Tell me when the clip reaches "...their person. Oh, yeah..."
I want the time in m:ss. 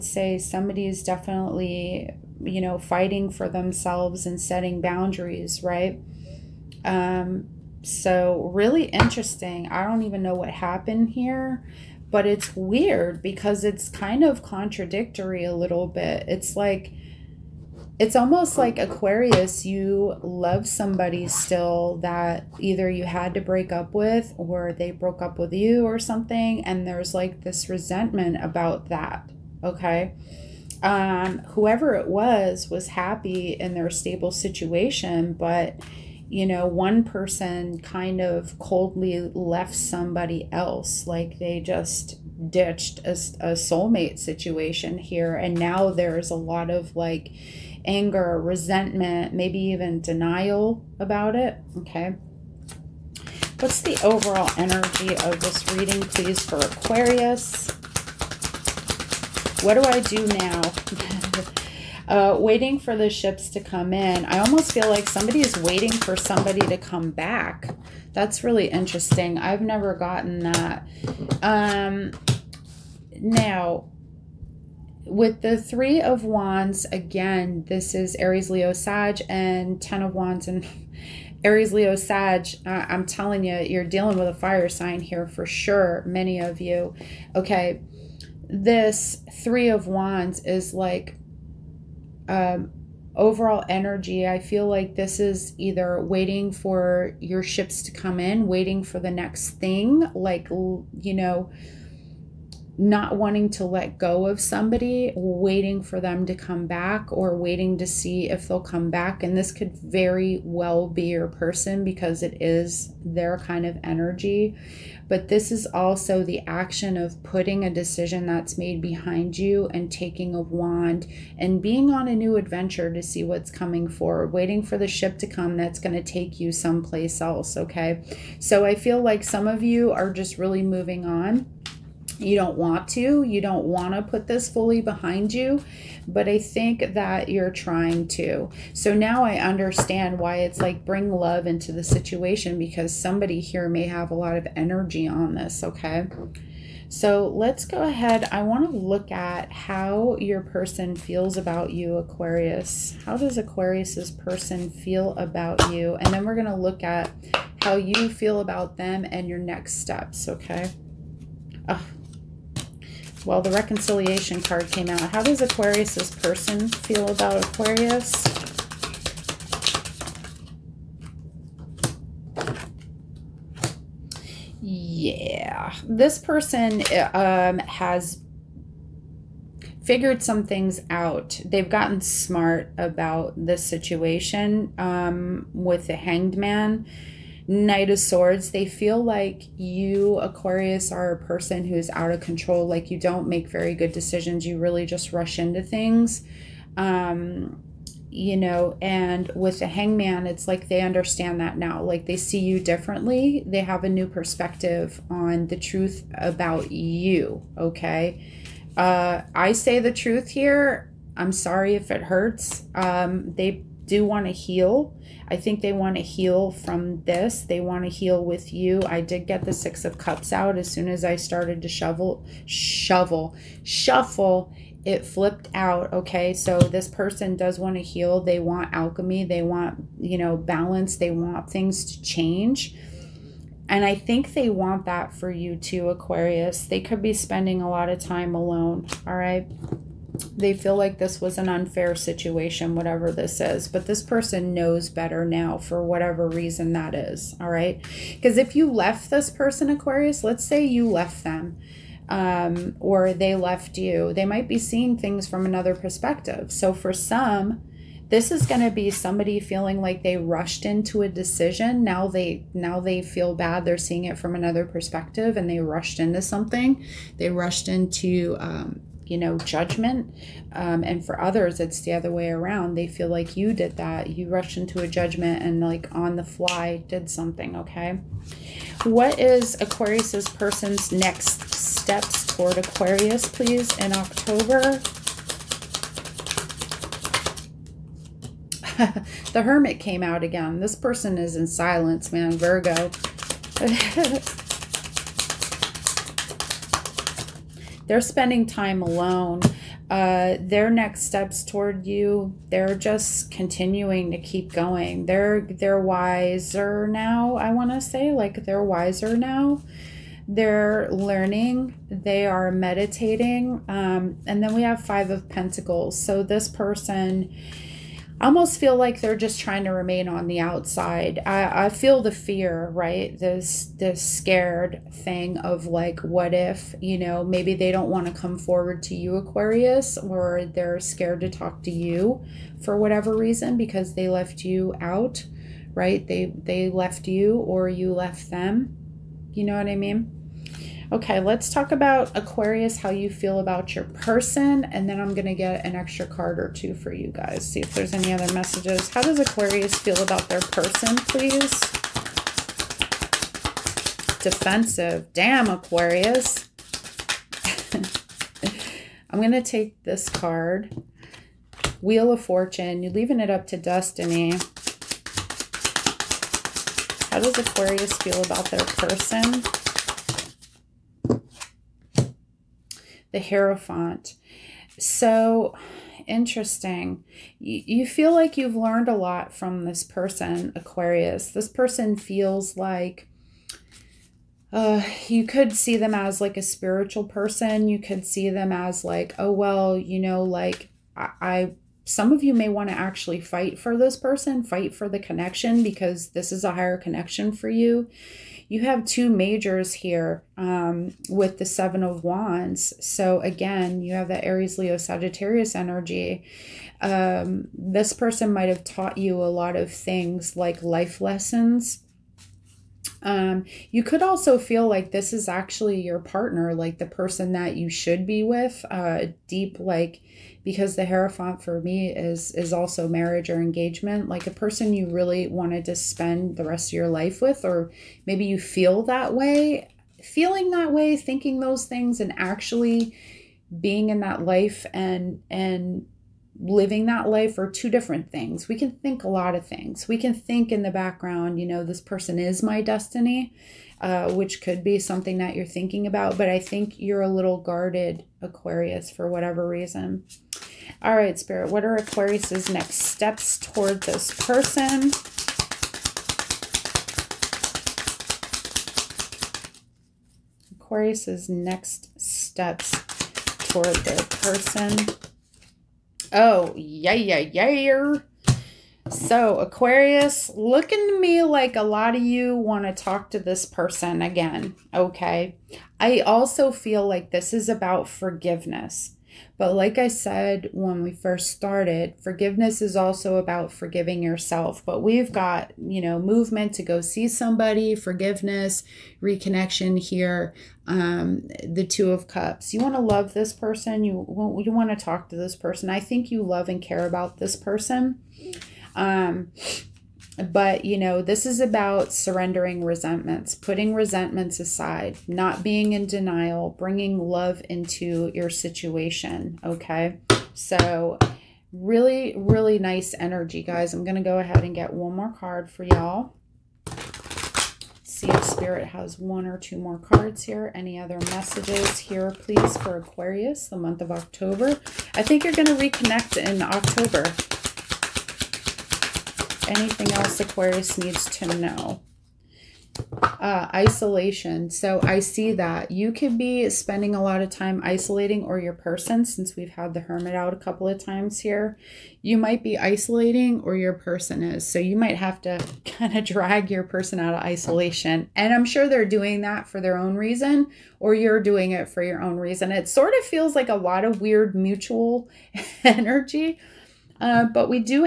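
7:43.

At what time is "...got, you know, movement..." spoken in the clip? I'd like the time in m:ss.
8:05.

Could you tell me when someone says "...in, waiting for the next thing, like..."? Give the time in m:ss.
1:38.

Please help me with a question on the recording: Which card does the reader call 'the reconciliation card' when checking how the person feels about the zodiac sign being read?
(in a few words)
6 of cups.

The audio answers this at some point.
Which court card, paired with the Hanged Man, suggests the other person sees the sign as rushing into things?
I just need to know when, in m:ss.
3:07.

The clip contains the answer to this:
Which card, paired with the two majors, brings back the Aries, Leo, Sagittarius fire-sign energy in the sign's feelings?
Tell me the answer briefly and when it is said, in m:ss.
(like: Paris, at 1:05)
Seven of Wands, at 6:41.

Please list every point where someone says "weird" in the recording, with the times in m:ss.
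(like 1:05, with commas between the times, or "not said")
0:12, 9:14.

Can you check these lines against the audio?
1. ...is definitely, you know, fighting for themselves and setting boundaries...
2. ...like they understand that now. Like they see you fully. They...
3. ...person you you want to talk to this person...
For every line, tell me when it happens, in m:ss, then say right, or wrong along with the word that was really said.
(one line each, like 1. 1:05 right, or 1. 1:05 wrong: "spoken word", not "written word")
1. 0:00 right
2. 3:20 wrong: "differently", not "fully"
3. 8:13 right.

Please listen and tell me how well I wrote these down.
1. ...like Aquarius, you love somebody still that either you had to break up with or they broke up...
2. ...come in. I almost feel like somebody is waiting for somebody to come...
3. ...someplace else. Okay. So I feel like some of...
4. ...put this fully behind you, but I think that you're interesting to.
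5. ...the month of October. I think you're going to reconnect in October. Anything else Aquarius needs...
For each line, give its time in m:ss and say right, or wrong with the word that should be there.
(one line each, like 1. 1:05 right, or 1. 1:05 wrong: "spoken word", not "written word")
1. 0:18 right
2. 1:03 right
3. 2:06 right
4. 2:14 wrong: "trying", not "interesting"
5. 8:43 right.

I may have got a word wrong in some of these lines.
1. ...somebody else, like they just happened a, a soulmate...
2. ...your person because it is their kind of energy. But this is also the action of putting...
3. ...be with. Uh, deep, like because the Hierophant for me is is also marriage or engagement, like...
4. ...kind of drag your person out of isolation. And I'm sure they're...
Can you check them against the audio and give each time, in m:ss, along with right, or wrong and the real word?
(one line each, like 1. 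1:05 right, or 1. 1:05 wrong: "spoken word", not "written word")
1. 0:39 wrong: "ditched", not "happened"
2. 1:51 right
3. 6:58 right
4. 9:05 right.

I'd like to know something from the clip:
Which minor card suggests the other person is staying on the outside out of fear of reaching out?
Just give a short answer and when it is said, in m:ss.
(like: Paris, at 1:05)
5 of pentacles, at 5:14.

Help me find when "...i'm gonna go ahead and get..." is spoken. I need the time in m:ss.
8:33.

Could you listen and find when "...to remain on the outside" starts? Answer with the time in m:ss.
5:19.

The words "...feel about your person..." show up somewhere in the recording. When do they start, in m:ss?
5:43.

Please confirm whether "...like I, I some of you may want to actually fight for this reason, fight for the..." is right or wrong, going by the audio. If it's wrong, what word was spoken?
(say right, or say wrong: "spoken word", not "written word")
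wrong: "person", not "reason".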